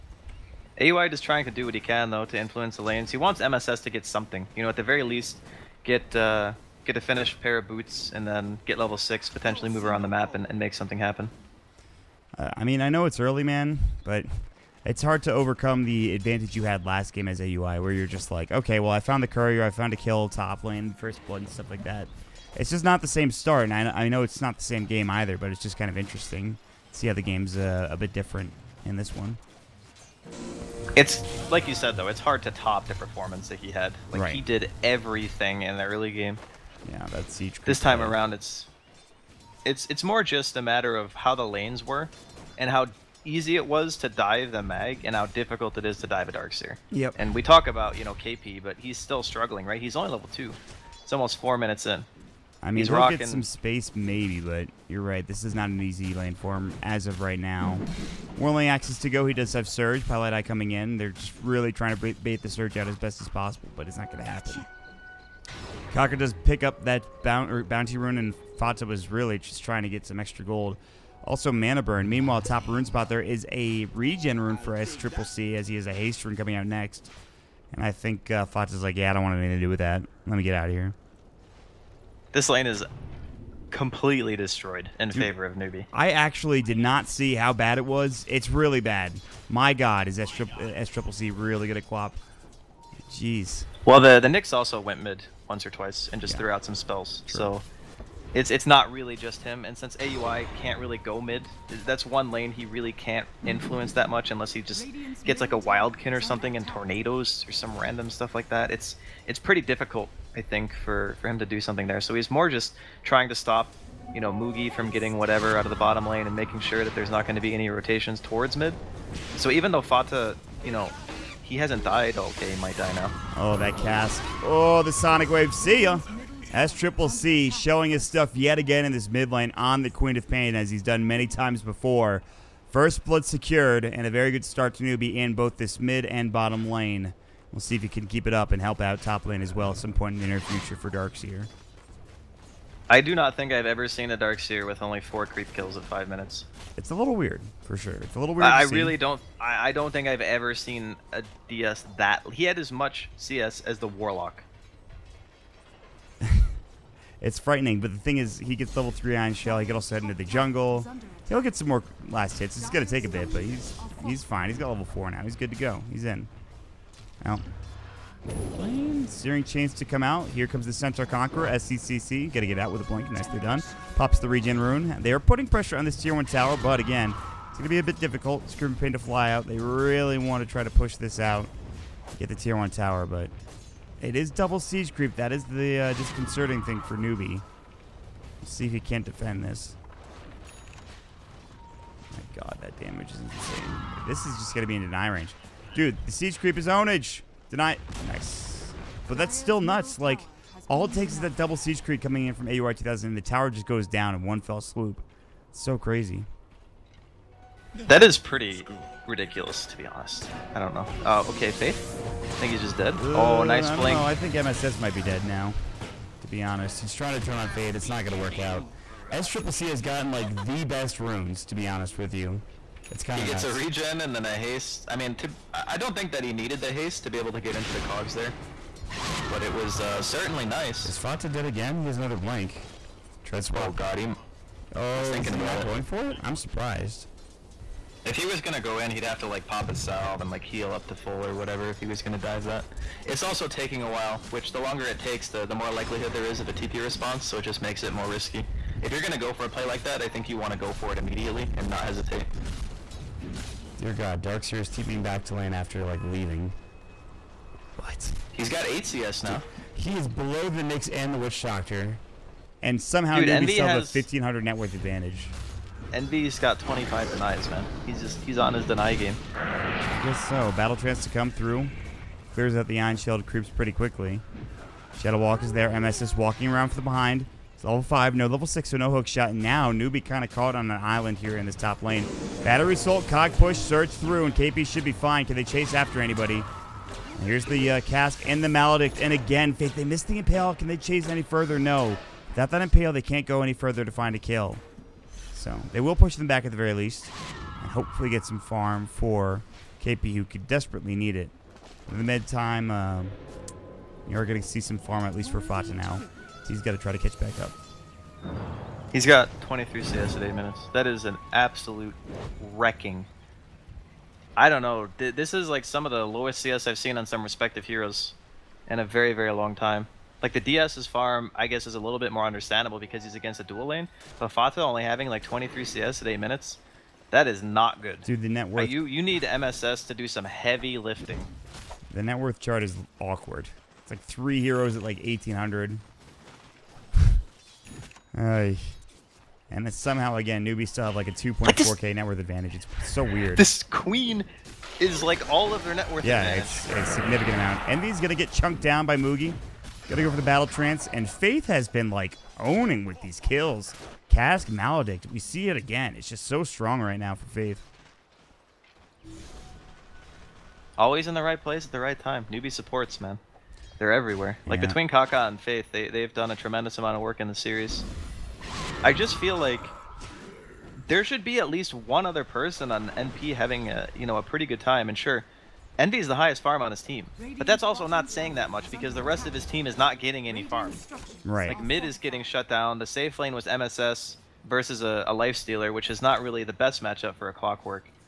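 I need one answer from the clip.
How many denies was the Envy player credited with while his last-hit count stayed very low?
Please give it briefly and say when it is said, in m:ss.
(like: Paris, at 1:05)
25, at 4:26.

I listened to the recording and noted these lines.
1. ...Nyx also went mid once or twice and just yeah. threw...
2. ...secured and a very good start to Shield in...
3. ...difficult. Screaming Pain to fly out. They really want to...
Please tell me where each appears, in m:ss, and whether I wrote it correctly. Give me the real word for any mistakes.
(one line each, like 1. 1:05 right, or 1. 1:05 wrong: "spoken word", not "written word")
1. 1:34 right
2. 2:13 wrong: "Newbee", not "Shield"
3. 2:57 right.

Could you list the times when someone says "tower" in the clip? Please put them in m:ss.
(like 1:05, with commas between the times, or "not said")
2:56, 3:02, 3:23.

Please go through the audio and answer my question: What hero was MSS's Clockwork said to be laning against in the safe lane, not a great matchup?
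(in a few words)
Life Stealer.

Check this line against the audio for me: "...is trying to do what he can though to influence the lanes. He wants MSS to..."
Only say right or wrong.
right.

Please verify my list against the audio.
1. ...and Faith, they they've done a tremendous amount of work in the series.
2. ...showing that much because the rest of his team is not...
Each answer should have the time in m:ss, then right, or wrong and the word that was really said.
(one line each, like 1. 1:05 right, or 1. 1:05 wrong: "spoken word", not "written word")
1. 6:05 right
2. 6:18 wrong: "saying", not "showing".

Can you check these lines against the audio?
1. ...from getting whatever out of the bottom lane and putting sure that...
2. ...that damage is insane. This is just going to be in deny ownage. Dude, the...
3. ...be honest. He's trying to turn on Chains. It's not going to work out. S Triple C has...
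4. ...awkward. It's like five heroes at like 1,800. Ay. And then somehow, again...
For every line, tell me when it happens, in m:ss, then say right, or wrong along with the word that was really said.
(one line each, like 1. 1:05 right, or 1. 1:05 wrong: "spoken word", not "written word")
1. 1:54 wrong: "making", not "putting"
2. 3:12 wrong: "range", not "ownage"
3. 3:36 wrong: "Faith", not "Chains"
4. 5:32 wrong: "three", not "five".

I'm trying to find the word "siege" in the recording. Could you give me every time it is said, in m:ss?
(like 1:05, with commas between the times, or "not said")
3:04, 3:16, 3:21.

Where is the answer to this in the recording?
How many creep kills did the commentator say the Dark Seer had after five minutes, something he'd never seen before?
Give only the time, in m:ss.
2:24.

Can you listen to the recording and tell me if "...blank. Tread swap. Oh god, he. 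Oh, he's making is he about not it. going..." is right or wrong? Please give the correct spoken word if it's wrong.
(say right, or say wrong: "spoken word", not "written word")
wrong: "thinking", not "making".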